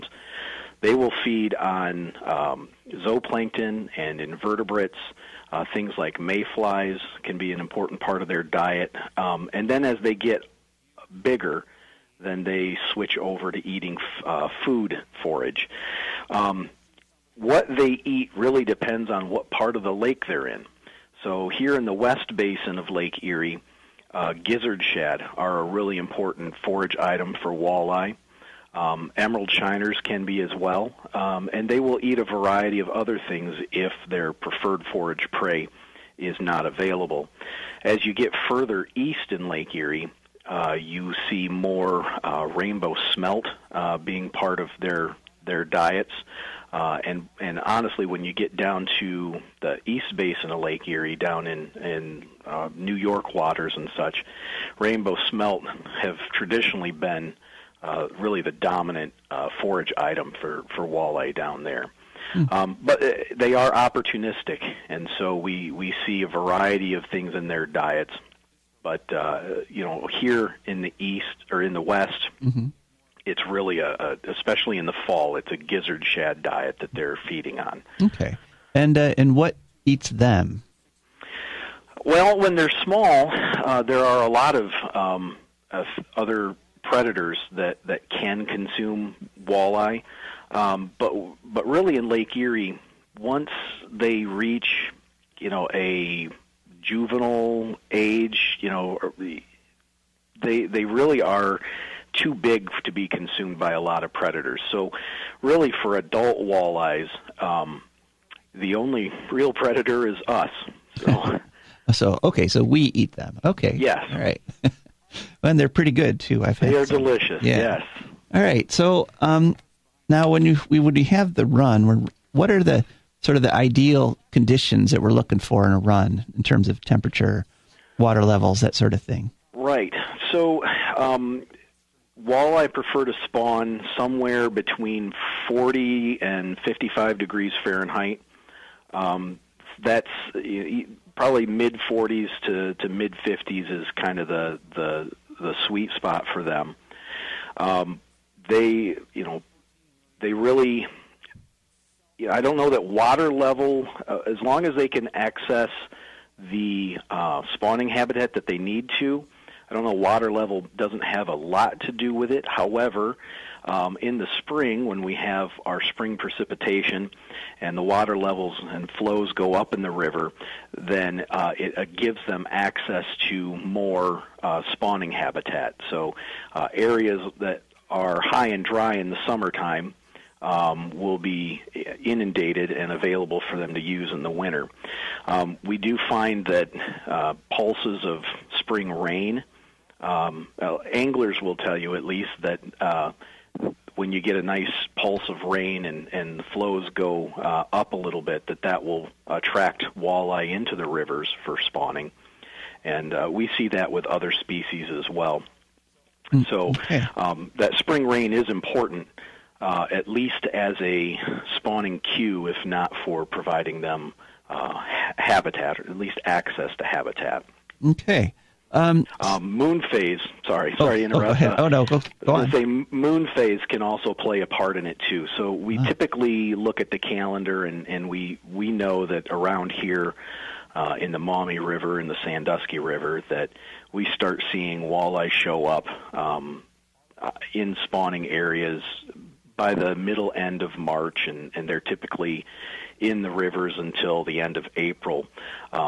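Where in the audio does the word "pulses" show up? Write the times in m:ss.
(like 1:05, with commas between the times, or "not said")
3:07, 3:14.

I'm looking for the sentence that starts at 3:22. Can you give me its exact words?
And uh, we see that with other species as well.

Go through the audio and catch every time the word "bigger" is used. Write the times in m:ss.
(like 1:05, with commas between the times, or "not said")
0:11.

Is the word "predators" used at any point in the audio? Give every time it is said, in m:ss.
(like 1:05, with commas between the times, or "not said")
1:26, 1:44, 1:49.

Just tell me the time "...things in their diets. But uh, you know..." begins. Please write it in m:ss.
1:07.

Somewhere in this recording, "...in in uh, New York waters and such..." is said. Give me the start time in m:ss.
0:51.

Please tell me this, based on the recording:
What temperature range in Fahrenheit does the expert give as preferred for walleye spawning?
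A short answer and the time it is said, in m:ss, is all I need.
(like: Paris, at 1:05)
40 to 55 degrees, at 2:15.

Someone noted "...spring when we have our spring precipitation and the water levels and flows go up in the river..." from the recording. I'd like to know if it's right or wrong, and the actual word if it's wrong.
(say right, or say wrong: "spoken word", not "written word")
right.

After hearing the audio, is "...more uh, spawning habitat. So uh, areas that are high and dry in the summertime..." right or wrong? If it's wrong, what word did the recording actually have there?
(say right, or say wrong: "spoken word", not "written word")
right.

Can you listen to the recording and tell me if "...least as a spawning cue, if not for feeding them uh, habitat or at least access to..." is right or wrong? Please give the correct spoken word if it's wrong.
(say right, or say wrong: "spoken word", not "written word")
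wrong: "providing", not "feeding".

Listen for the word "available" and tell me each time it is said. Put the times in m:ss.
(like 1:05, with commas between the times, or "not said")
0:36, 3:02.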